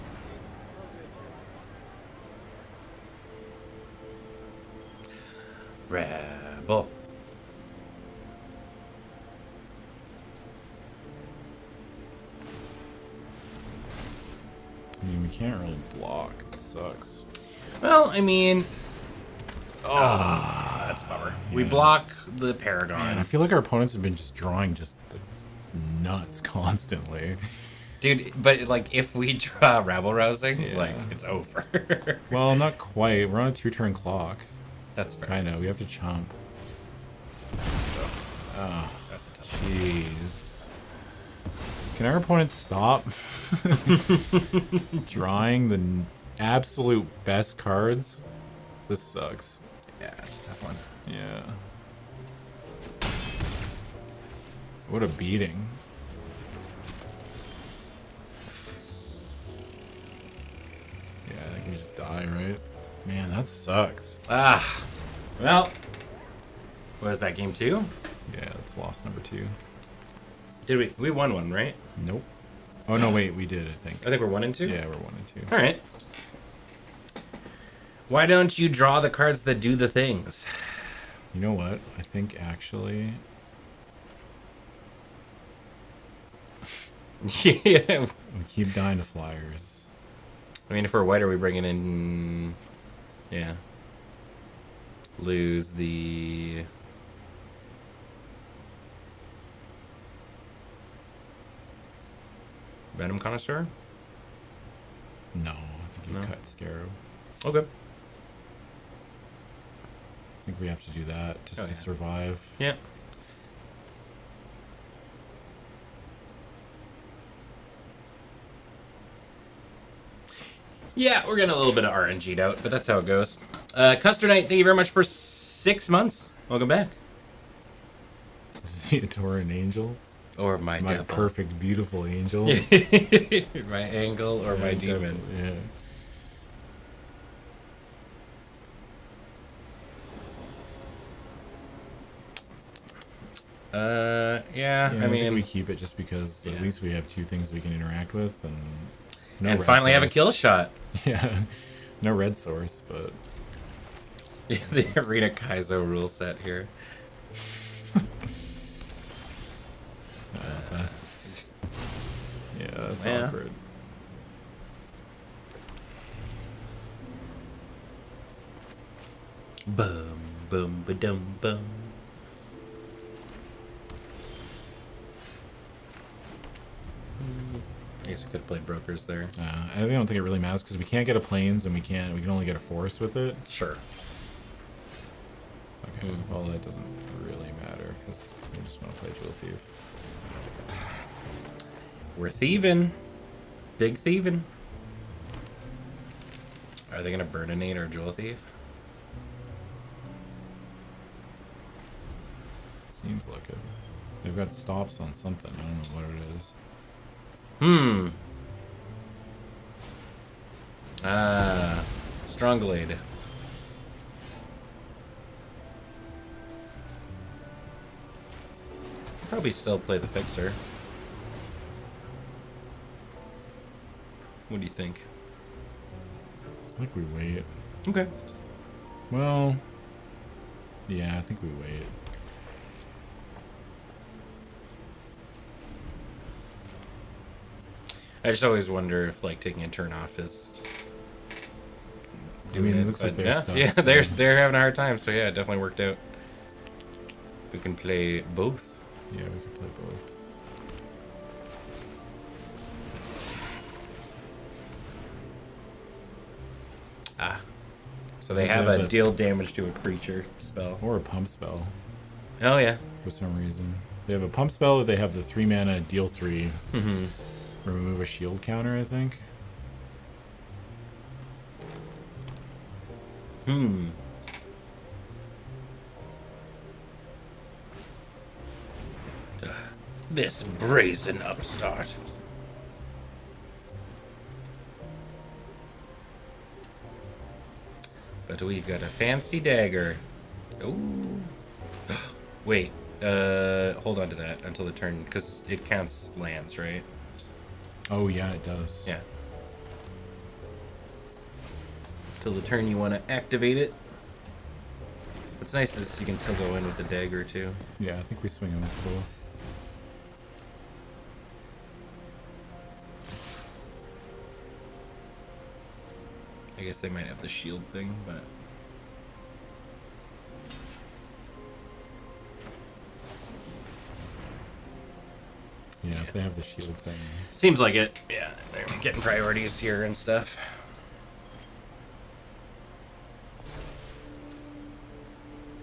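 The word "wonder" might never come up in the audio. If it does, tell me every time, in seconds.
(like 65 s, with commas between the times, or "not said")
238 s.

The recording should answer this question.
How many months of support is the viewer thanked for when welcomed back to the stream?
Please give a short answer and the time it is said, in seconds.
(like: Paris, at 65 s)
6, at 125 s.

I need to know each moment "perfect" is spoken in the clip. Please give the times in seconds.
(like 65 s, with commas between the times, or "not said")
131 s.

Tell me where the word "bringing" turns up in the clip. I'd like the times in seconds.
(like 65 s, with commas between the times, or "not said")
91 s.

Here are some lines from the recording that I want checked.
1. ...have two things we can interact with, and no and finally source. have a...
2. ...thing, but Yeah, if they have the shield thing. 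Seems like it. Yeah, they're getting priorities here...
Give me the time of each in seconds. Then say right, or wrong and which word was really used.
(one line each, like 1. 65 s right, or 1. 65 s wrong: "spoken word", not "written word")
1. 146 s right
2. 317 s right.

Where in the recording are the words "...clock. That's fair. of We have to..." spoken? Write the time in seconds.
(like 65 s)
33 s.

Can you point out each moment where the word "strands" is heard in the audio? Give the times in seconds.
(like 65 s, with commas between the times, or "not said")
not said.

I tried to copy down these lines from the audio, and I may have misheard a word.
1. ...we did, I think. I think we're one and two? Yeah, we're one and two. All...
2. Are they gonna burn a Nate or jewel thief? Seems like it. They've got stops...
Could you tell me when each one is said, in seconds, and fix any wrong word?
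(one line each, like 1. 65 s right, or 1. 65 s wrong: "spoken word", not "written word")
1. 73 s right
2. 196 s right.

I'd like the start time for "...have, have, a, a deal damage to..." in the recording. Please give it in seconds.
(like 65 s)
258 s.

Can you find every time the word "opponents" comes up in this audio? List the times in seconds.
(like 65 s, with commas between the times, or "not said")
23 s, 42 s.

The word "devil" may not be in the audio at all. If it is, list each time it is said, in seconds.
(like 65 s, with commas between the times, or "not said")
130 s, 135 s.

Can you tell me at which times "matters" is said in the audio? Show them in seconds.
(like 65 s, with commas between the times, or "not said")
180 s, 187 s.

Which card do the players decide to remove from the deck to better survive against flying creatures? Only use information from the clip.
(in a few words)
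Scarab.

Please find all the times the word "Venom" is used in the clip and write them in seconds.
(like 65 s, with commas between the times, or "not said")
102 s.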